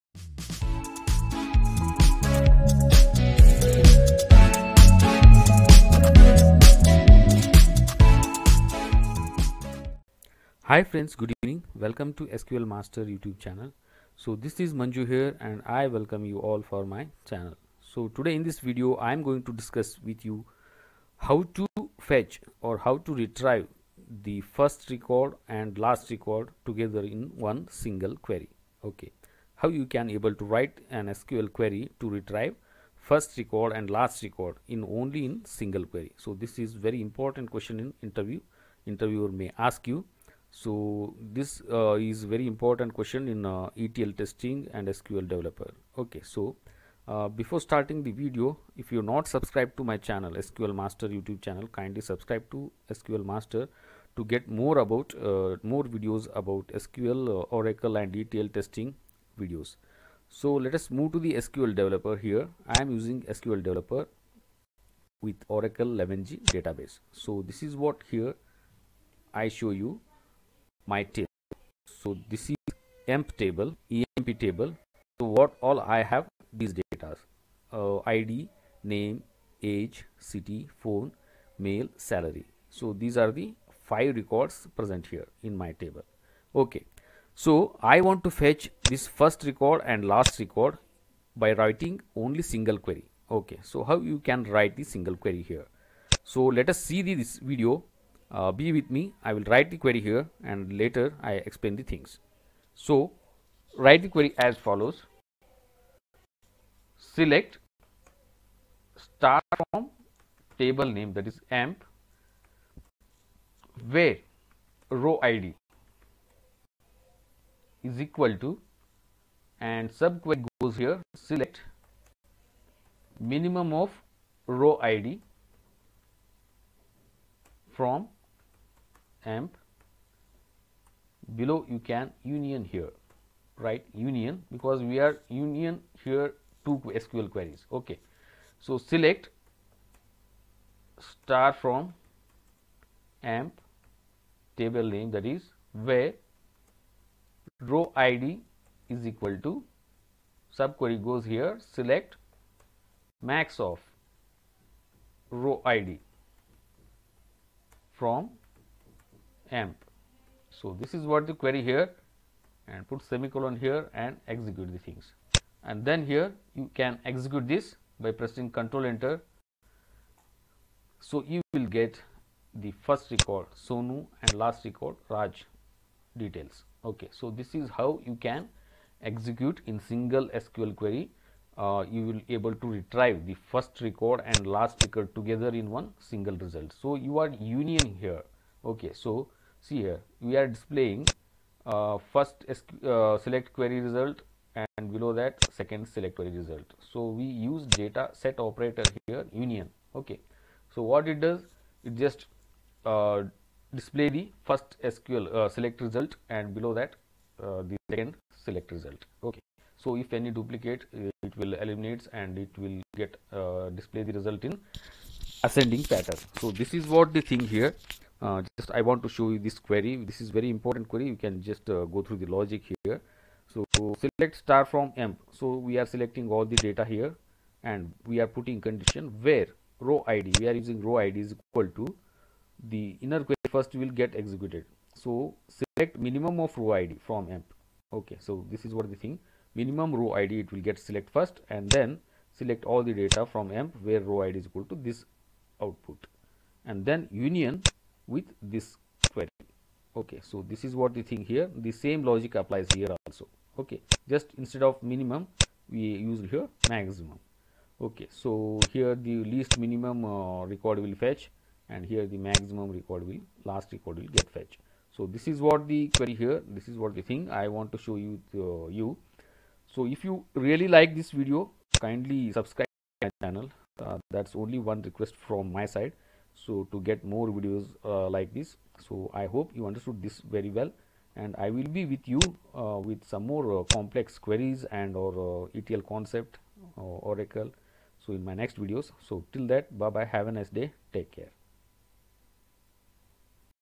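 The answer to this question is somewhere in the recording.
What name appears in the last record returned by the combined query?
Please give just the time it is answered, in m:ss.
2:55.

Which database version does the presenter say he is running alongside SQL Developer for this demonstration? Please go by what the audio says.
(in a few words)
Oracle 11g.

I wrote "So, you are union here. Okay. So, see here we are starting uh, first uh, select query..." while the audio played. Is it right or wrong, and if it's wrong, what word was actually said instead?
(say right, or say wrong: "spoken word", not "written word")
wrong: "displaying", not "starting".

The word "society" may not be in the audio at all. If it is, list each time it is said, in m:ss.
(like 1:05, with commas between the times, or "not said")
not said.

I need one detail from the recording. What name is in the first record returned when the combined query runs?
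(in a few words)
Sonu.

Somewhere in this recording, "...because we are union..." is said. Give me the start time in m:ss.
2:14.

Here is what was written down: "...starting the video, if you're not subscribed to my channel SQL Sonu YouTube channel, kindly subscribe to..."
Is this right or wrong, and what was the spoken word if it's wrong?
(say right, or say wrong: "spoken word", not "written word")
wrong: "Master", not "Sonu".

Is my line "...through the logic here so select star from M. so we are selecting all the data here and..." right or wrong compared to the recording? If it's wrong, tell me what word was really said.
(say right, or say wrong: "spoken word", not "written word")
right.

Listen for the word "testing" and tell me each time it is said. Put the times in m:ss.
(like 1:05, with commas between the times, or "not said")
0:44, 0:58.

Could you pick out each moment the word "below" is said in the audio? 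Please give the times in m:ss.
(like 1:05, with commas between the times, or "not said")
2:11, 3:14, 3:26.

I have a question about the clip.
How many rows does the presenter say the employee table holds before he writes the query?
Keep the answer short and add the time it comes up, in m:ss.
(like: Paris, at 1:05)
5, at 1:23.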